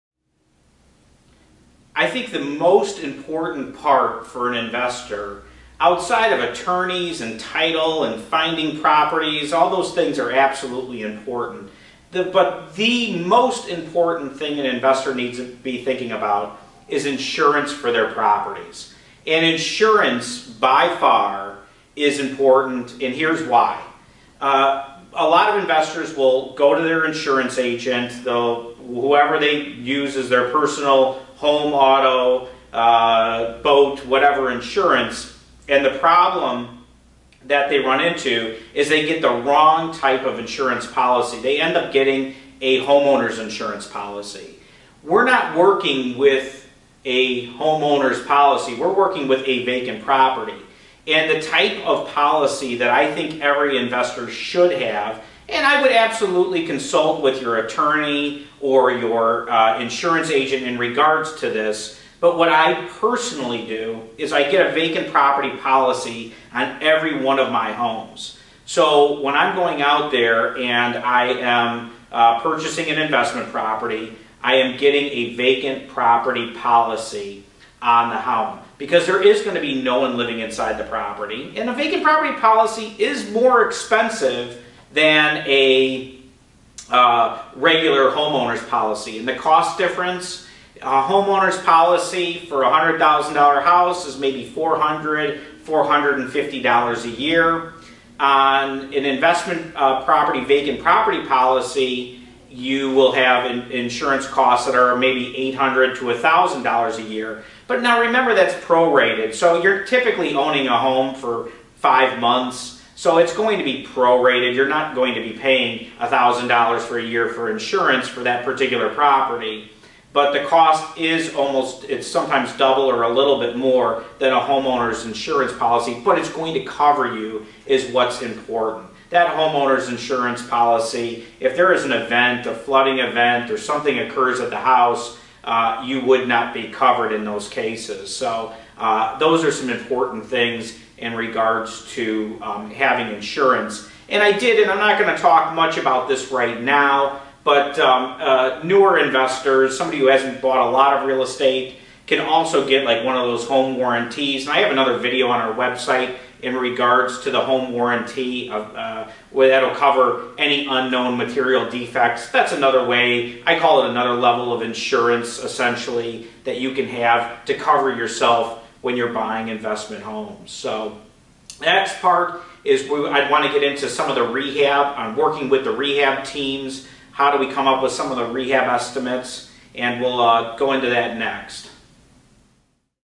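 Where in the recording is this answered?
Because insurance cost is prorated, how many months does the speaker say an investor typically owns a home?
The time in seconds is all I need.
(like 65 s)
111 s.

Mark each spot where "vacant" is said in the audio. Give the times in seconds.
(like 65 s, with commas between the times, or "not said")
49 s, 64 s, 75 s, 81 s, 100 s.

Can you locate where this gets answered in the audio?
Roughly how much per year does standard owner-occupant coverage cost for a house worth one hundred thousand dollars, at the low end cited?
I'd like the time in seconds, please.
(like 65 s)
94 s.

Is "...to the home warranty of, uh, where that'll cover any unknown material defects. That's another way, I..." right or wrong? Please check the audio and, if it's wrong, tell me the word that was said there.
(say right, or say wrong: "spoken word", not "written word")
right.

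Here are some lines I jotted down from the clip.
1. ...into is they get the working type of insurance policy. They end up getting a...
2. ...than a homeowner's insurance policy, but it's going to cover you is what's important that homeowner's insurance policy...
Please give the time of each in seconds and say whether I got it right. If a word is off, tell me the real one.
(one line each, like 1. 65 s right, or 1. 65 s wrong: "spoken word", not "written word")
1. 38 s wrong: "wrong", not "working"
2. 124 s right.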